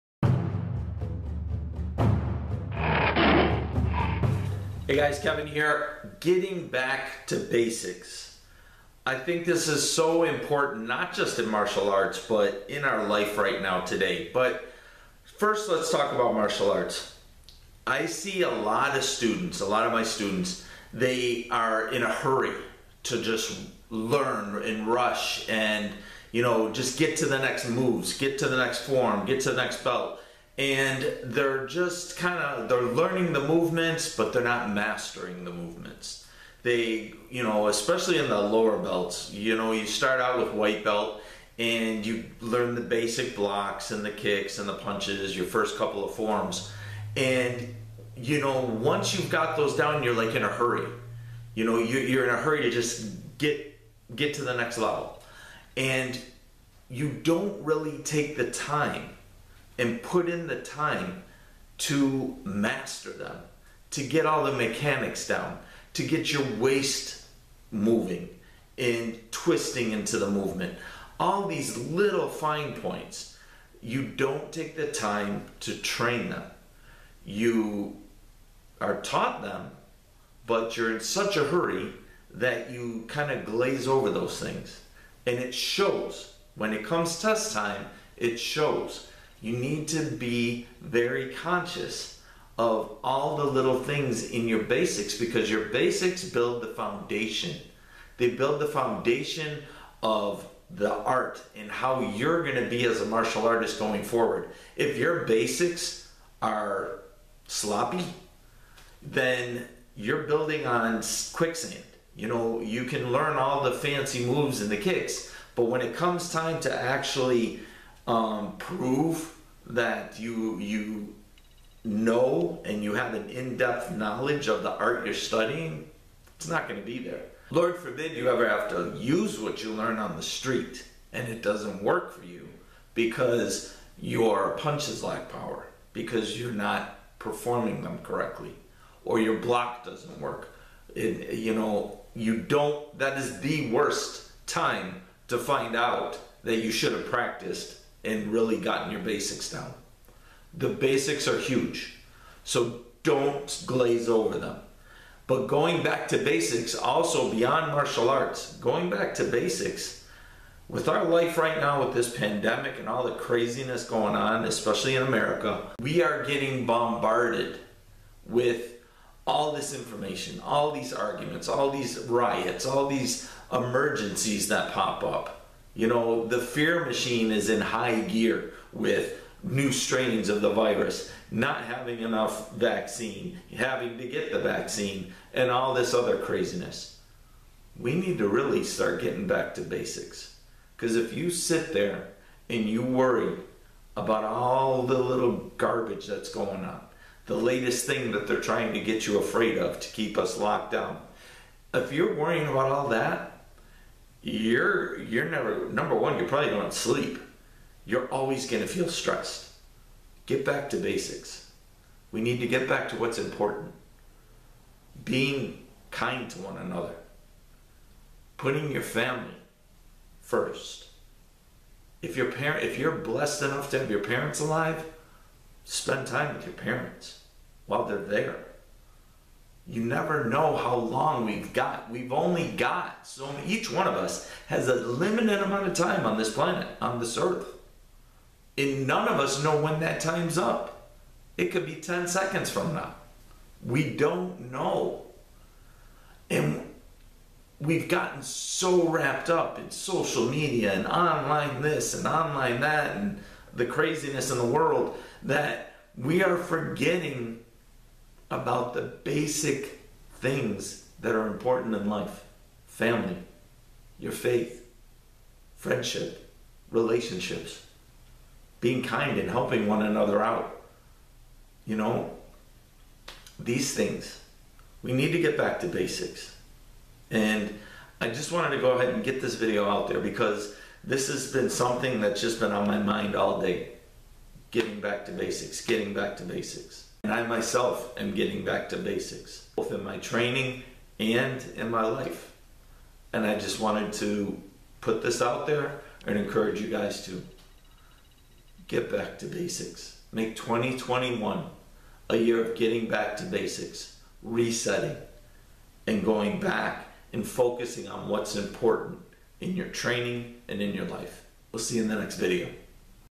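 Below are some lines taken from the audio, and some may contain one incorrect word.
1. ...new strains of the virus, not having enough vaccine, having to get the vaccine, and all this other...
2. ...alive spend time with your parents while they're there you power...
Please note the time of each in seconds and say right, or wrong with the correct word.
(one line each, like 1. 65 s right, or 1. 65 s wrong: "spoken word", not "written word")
1. 179 s right
2. 224 s wrong: "never", not "power".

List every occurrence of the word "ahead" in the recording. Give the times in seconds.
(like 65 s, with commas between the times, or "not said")
278 s.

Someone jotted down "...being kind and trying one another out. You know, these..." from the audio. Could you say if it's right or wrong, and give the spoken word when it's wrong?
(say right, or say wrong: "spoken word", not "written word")
wrong: "helping", not "trying".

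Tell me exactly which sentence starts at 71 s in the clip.
All these little fine points, you don't take the time to train them.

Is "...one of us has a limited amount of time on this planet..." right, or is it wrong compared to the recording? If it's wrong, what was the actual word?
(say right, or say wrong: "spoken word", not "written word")
right.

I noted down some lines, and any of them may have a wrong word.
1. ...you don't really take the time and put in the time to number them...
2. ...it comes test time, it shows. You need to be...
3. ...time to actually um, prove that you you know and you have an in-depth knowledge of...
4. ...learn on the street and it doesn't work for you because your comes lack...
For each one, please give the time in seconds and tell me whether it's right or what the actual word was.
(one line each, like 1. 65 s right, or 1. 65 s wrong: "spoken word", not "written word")
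1. 56 s wrong: "master", not "number"
2. 86 s right
3. 116 s right
4. 129 s wrong: "punches", not "comes".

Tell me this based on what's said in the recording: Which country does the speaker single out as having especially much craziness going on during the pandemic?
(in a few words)
America.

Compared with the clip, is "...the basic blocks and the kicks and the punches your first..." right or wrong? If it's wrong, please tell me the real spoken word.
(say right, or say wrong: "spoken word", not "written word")
right.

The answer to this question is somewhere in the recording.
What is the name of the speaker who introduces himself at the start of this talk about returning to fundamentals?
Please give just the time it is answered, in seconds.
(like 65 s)
5 s.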